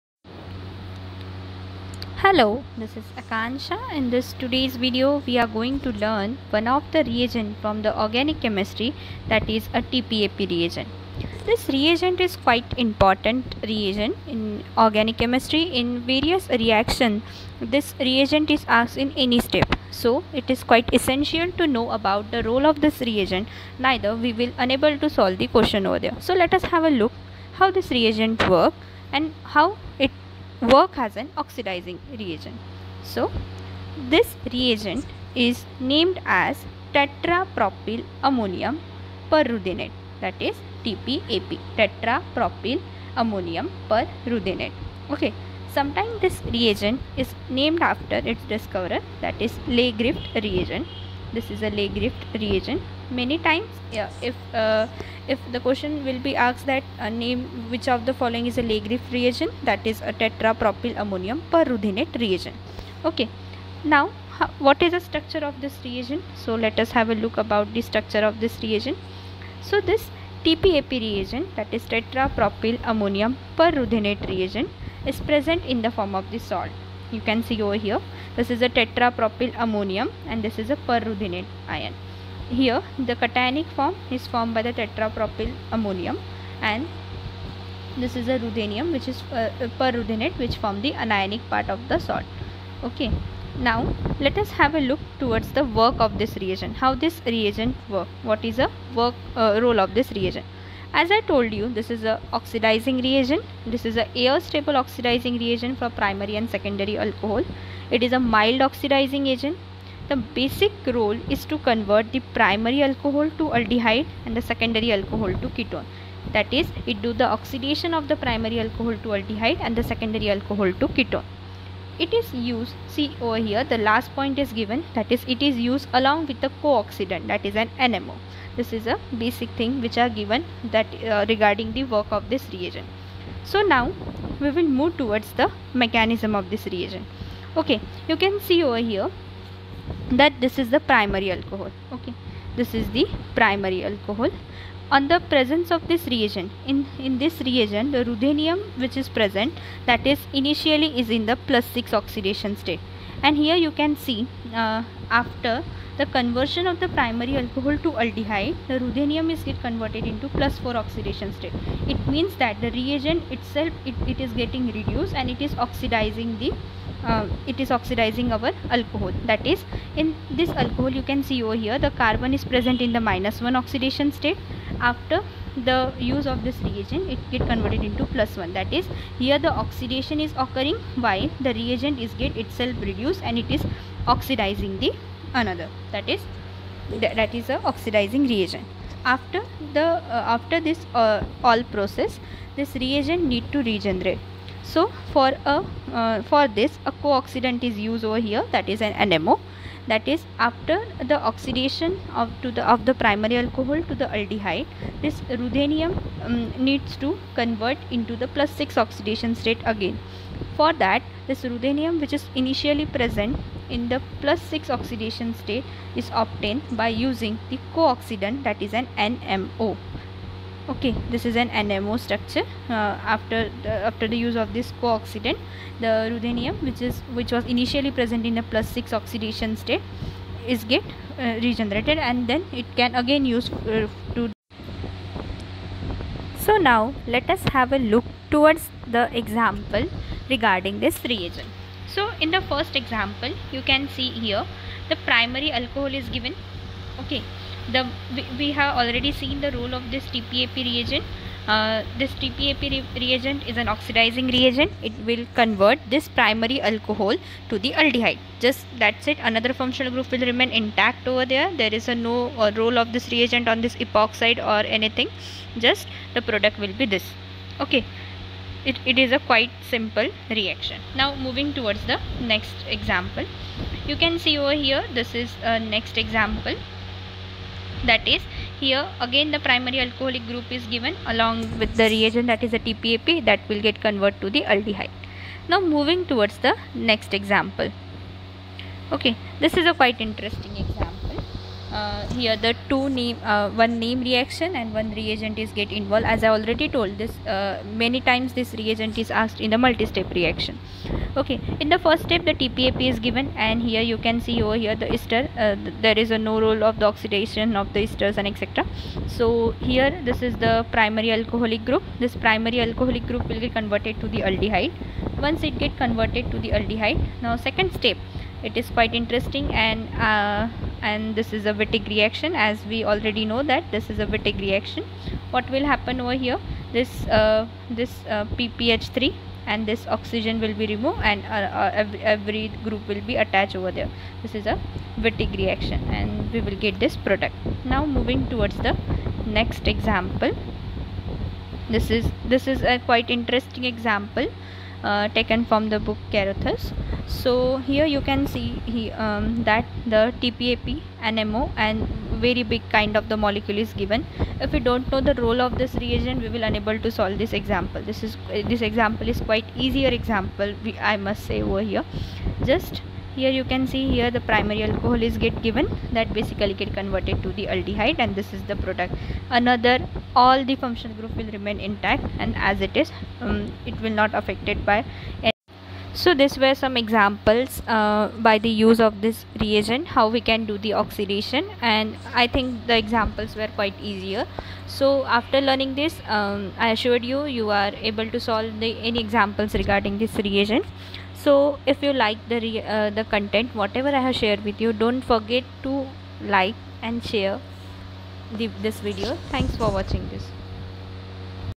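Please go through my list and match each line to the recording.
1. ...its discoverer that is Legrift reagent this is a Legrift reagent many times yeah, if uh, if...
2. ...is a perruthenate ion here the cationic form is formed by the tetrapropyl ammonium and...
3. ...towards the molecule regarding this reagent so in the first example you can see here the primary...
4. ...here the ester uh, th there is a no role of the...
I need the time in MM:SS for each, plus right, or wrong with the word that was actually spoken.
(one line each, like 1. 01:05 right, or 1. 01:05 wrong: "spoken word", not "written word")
1. 00:48 right
2. 01:20 right
3. 03:58 wrong: "example", not "molecule"
4. 05:04 right.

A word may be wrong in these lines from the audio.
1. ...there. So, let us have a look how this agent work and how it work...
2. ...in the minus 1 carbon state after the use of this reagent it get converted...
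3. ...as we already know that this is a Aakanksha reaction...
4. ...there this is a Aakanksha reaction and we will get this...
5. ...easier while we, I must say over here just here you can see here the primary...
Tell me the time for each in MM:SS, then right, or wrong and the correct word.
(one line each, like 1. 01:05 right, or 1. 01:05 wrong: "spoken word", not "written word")
1. 00:26 wrong: "reagent", not "agent"
2. 02:52 wrong: "oxidation", not "carbon"
3. 05:22 wrong: "Wittig", not "Aakanksha"
4. 05:33 wrong: "Wittig", not "Aakanksha"
5. 05:59 wrong: "example", not "while".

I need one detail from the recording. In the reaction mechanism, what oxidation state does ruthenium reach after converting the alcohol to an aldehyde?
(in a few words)
+4.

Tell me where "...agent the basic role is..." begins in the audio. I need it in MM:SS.
01:49.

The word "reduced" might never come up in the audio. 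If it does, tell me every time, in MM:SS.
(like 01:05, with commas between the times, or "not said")
02:44, 03:02.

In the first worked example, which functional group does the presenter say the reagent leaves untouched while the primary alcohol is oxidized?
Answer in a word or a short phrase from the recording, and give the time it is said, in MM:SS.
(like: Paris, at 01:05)
epoxide, at 04:23.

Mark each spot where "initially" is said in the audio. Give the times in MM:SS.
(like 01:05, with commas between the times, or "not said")
02:30, 03:32, 03:47.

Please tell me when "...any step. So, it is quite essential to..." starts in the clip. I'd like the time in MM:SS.
00:19.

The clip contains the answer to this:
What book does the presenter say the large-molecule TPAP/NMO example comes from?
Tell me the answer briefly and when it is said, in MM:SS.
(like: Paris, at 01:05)
Carruthers, at 05:46.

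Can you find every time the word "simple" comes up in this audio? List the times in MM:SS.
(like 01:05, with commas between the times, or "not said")
04:29.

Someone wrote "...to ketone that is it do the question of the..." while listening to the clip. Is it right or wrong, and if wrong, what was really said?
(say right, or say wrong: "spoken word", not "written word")
wrong: "oxidation", not "question".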